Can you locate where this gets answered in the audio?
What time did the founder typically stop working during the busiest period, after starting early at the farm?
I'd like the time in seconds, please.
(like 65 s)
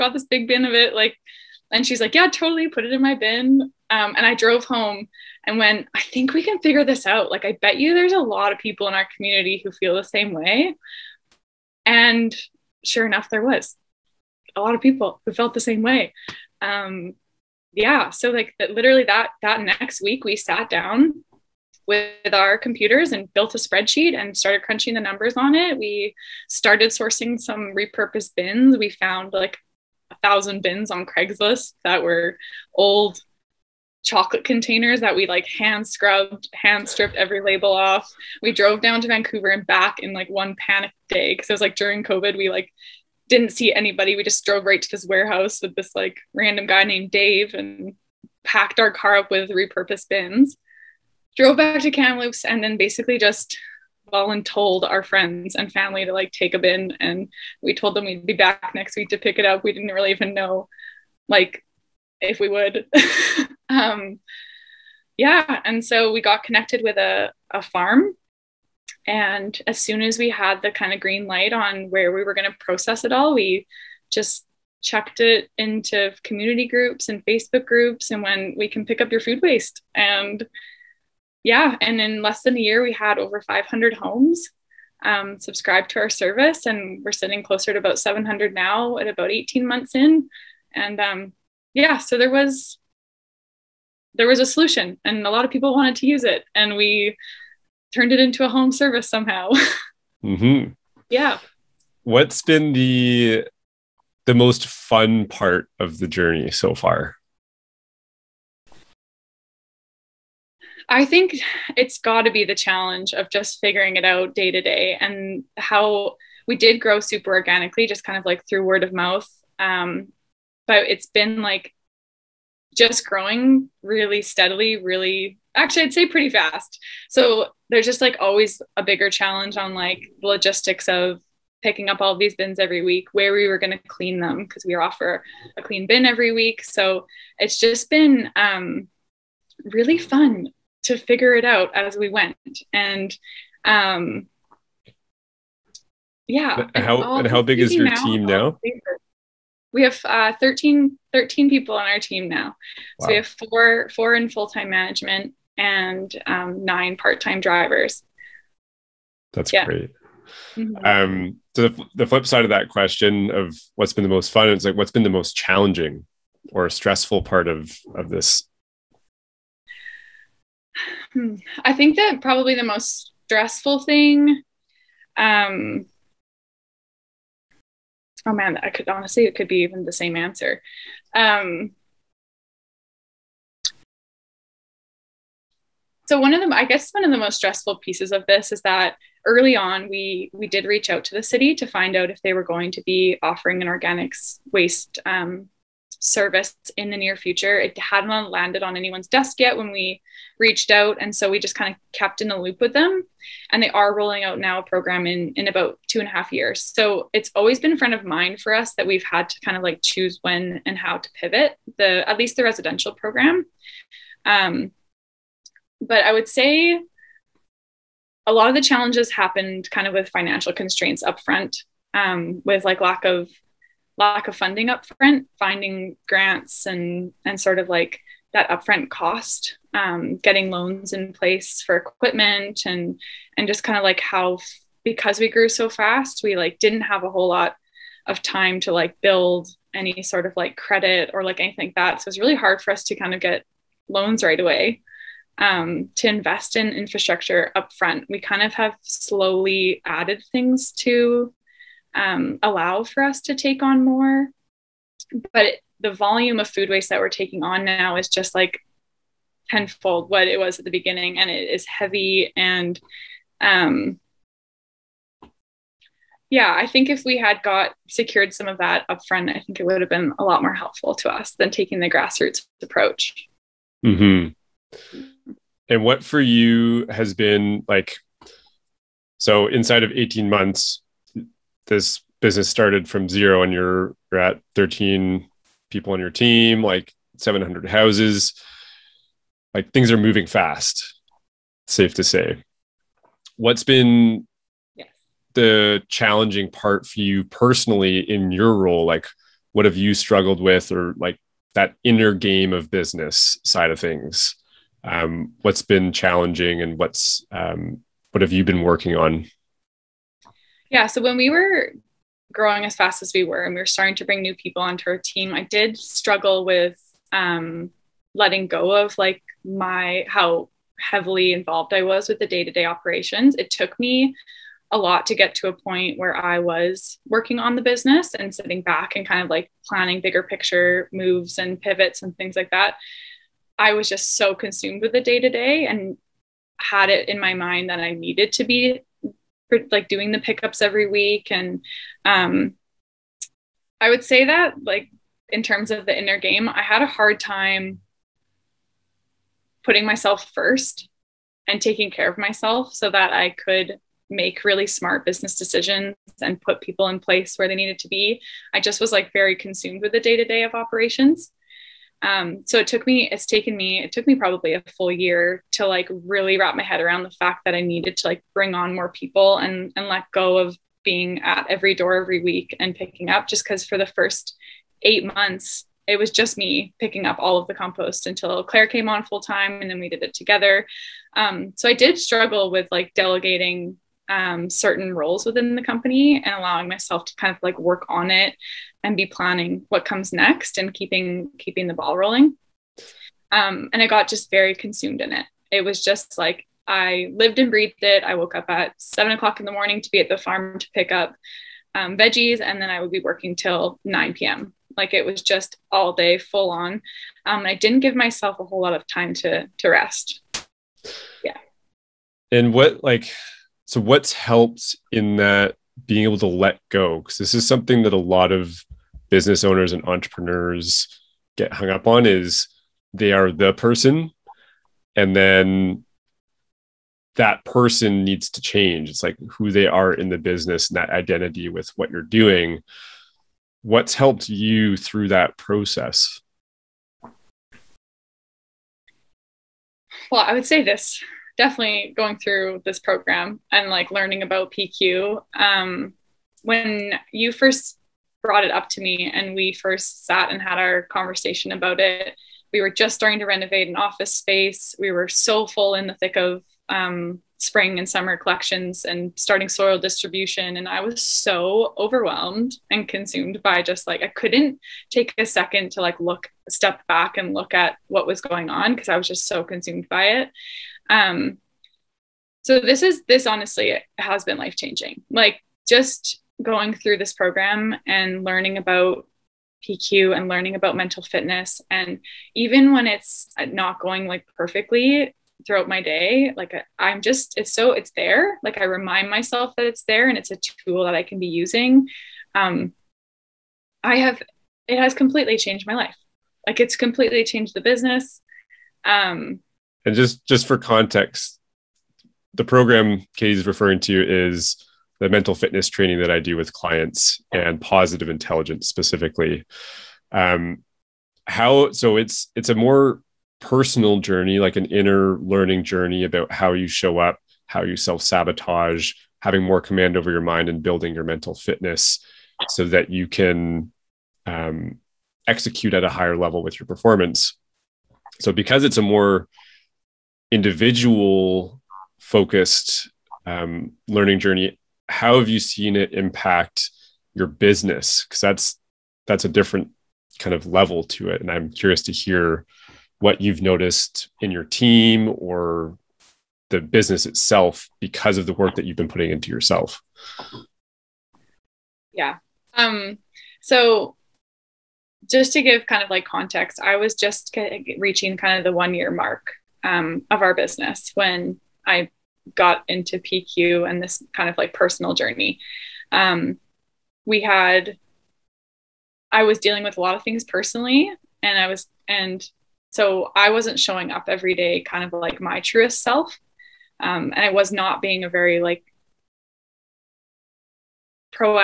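403 s.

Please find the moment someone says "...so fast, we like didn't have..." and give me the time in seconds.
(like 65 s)
235 s.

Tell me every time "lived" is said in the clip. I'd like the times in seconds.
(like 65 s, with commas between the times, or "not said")
397 s.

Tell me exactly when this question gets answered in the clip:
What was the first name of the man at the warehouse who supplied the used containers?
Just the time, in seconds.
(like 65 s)
47 s.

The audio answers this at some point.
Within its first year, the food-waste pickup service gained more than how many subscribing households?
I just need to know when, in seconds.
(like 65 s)
83 s.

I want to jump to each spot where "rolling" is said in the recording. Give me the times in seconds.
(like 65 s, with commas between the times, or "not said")
203 s, 391 s.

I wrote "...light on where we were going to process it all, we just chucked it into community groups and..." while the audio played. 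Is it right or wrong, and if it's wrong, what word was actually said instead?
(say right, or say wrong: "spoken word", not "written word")
right.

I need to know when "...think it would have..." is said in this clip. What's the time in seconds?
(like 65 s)
269 s.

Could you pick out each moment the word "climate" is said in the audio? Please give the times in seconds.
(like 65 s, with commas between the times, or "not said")
not said.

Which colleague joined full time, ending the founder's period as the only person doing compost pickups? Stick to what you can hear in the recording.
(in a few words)
Claire.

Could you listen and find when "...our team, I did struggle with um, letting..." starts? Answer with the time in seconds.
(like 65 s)
314 s.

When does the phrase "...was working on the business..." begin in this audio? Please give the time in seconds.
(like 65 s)
326 s.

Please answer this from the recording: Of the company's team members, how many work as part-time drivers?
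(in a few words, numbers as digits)
9.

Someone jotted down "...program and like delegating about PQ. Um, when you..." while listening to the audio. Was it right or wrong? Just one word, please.
wrong.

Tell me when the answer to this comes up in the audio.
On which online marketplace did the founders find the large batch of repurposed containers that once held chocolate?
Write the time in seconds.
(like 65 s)
31 s.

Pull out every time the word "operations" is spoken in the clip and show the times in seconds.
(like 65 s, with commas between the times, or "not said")
322 s, 360 s.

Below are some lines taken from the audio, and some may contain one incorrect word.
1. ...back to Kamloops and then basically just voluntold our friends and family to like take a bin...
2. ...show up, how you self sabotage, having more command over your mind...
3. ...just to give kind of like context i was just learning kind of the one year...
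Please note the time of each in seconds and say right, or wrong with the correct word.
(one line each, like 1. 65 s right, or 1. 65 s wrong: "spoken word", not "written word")
1. 51 s right
2. 516 s right
3. 555 s wrong: "reaching", not "learning".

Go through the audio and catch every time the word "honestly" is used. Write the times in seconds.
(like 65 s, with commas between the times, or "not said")
178 s, 473 s.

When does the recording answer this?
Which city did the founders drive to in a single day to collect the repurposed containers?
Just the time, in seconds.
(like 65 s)
39 s.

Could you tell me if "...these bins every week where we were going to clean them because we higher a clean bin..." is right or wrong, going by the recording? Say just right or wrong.
wrong.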